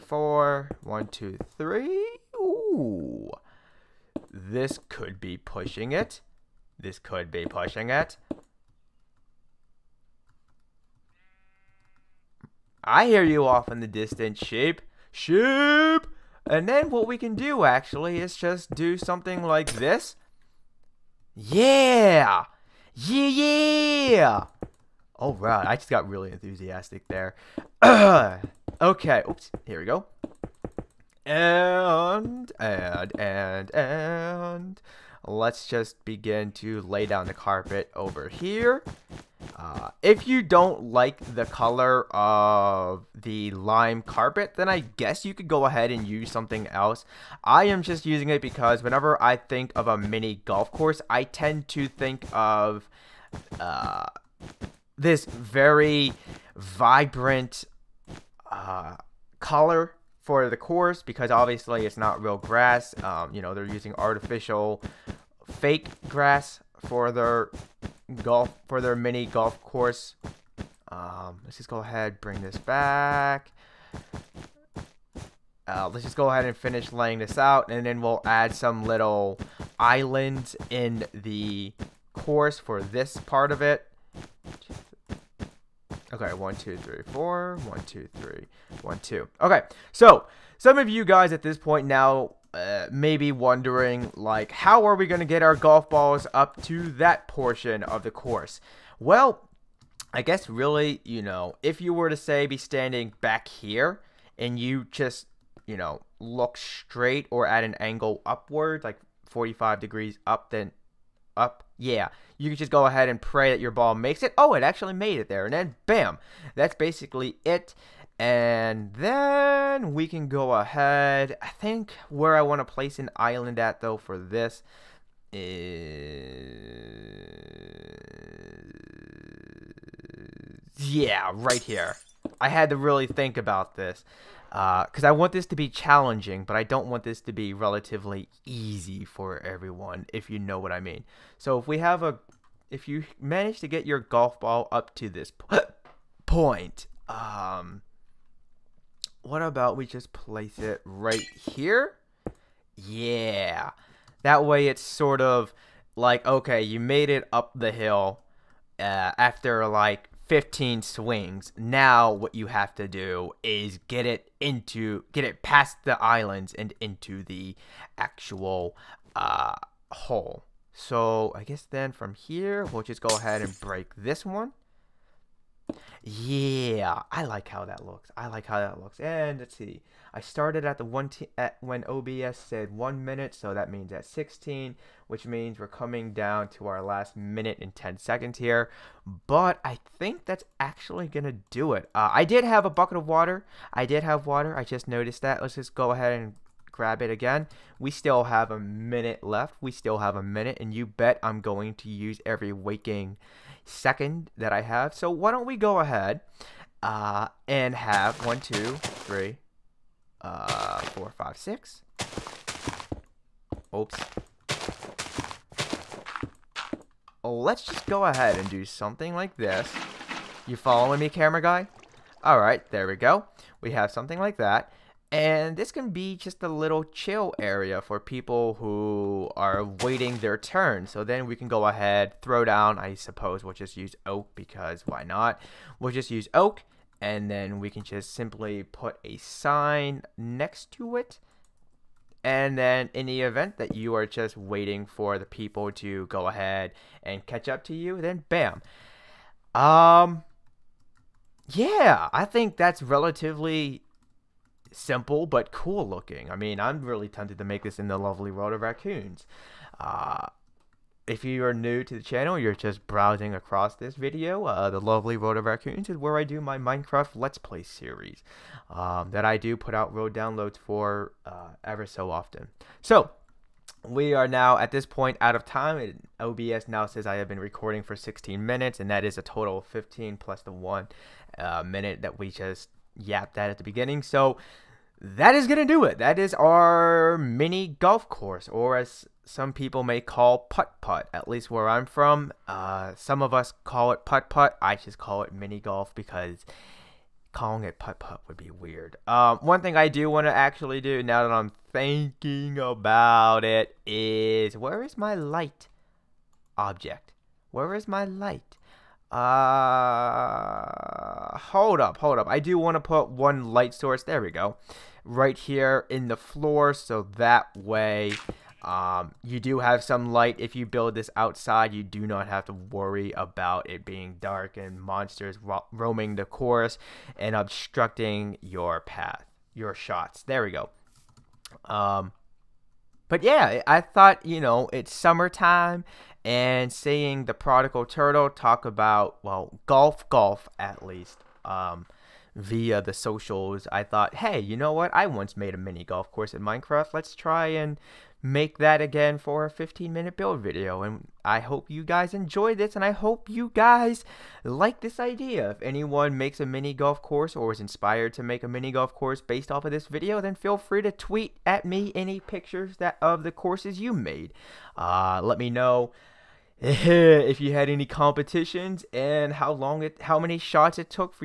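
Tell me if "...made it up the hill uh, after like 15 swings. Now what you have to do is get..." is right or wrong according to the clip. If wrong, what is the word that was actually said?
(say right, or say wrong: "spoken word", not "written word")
right.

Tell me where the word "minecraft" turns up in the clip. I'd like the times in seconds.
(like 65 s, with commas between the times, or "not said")
266 s, 346 s.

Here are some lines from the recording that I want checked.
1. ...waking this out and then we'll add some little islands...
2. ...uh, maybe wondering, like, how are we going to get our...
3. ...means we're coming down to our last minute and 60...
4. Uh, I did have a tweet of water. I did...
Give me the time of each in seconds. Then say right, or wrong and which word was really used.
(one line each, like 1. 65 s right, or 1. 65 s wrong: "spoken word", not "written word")
1. 76 s wrong: "laying", not "waking"
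2. 92 s right
3. 185 s wrong: "10", not "60"
4. 191 s wrong: "bucket", not "tweet".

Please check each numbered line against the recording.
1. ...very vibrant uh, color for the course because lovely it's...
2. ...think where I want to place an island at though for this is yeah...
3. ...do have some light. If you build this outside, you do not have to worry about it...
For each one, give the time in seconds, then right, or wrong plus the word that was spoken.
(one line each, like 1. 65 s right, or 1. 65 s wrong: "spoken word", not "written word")
1. 55 s wrong: "obviously", not "lovely"
2. 121 s right
3. 319 s right.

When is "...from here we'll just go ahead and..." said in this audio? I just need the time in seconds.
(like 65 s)
171 s.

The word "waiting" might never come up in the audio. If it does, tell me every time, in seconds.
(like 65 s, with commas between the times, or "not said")
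229 s, 244 s.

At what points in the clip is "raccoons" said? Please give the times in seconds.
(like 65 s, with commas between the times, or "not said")
258 s, 265 s.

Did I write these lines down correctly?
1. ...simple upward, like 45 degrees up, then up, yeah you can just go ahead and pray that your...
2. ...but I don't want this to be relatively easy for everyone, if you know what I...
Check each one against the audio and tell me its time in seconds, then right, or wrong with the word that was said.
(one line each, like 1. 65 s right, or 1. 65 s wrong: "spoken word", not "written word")
1. 107 s wrong: "angle", not "simple"
2. 136 s right.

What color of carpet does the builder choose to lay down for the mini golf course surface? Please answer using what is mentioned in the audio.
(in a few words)
Lime.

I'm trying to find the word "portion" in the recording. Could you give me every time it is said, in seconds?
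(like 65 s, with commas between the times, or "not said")
97 s.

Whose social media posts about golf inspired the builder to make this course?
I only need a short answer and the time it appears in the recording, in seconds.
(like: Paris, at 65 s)
The Prodigal Turtle, at 337 s.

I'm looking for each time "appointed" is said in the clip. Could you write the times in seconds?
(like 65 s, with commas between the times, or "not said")
not said.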